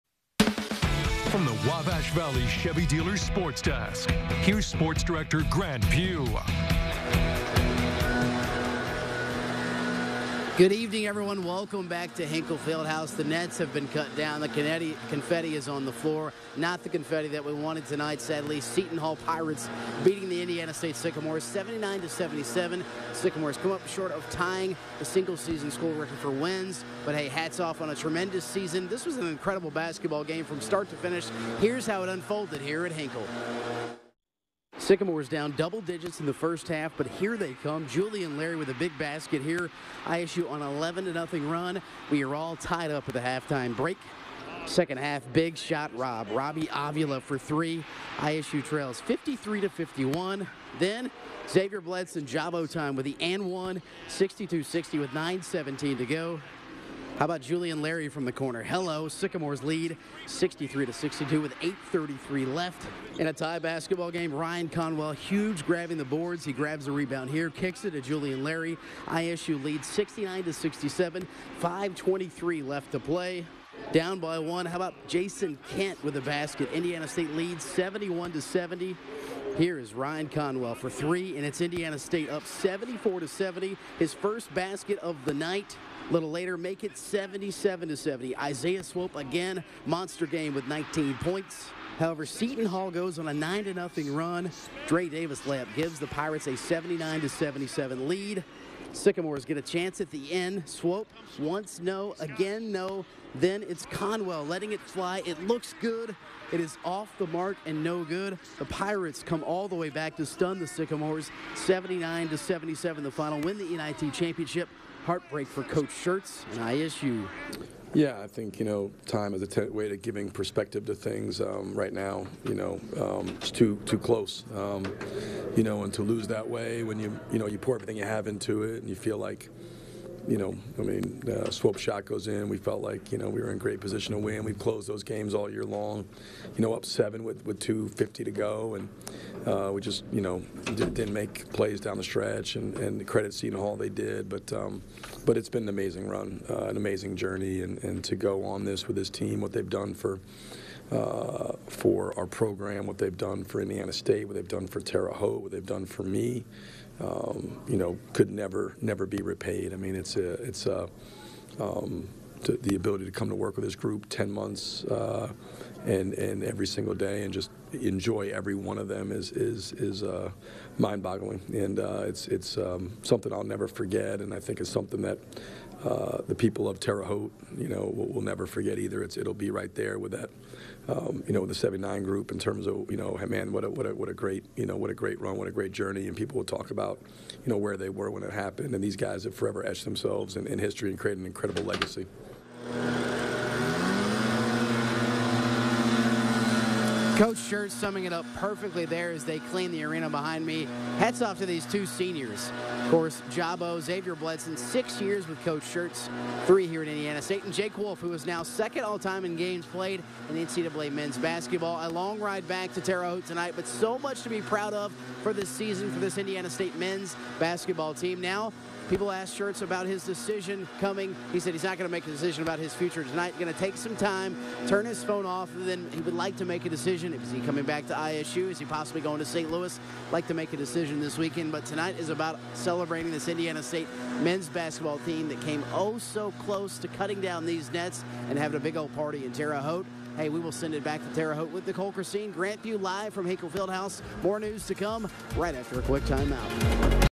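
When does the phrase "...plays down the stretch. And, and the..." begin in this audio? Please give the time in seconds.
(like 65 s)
141 s.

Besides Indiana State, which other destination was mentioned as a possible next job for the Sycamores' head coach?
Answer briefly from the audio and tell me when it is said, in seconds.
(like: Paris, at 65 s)
St. Louis, at 229 s.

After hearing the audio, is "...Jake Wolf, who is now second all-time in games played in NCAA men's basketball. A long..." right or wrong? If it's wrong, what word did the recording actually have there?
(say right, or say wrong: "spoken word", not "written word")
right.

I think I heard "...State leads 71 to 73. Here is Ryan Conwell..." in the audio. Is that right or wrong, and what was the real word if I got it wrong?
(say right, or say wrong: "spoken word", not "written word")
wrong: "70", not "73".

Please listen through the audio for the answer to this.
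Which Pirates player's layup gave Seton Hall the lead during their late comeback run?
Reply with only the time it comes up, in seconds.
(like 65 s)
94 s.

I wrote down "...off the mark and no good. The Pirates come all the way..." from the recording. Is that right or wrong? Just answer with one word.
right.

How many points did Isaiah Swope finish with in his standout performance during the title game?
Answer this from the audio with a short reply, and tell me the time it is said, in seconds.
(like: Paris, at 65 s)
19, at 90 s.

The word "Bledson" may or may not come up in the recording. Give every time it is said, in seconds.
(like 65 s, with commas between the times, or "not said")
51 s, 204 s.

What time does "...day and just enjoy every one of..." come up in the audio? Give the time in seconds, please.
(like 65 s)
166 s.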